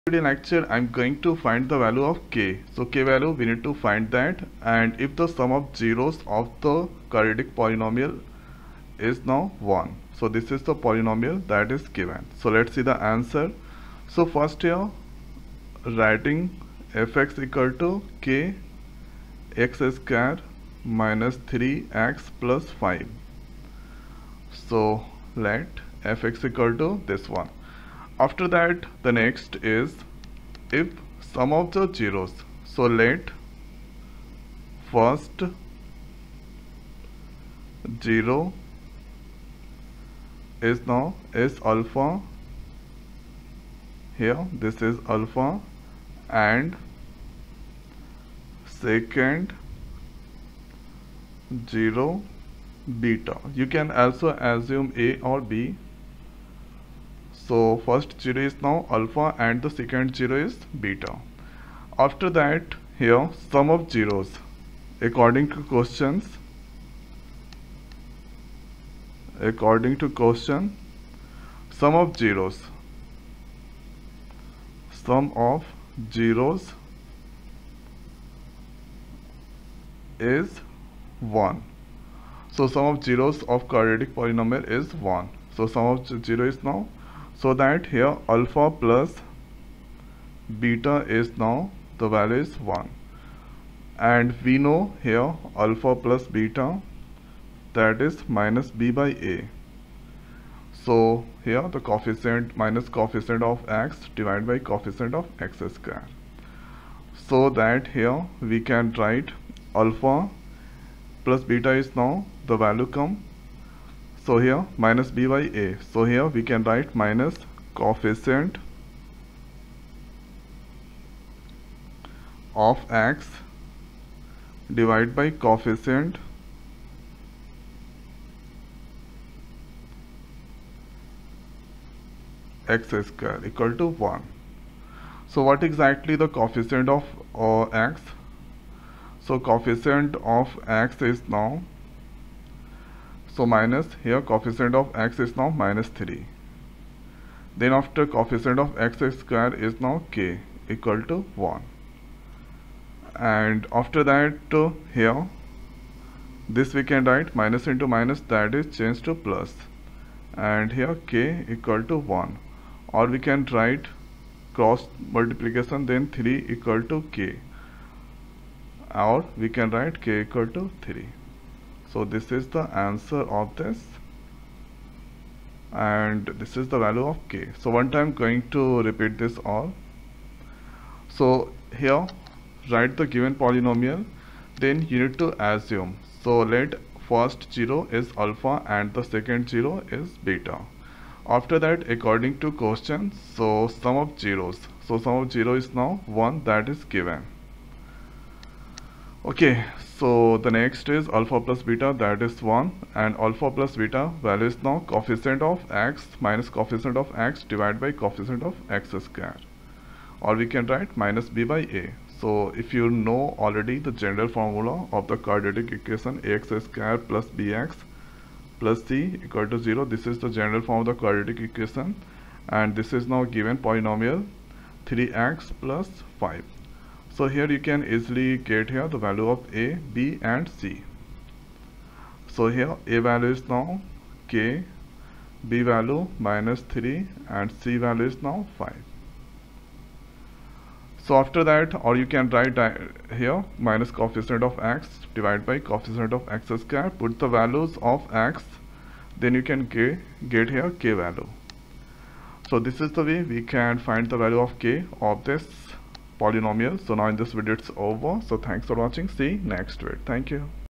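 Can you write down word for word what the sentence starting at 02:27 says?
Then after coefficient of x square is now k equal to 1.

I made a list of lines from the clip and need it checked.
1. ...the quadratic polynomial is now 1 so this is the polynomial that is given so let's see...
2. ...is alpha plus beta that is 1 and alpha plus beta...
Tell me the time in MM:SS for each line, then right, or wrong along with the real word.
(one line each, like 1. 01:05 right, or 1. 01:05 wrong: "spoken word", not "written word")
1. 00:06 right
2. 03:20 right.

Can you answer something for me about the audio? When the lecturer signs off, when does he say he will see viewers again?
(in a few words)
next week.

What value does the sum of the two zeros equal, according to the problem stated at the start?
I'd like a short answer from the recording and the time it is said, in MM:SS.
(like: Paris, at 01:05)
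1, at 01:15.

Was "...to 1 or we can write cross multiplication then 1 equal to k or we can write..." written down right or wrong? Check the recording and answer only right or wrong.
wrong.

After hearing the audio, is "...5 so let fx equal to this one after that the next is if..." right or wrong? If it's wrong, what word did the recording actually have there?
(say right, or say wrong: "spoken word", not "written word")
right.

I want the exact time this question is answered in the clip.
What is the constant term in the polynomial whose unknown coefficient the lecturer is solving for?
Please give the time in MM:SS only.
03:57.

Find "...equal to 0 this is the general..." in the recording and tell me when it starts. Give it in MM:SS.
03:39.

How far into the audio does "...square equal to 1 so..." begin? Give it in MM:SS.
02:13.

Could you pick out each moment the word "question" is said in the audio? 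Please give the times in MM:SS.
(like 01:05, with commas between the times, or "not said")
01:05, 01:10, 03:12.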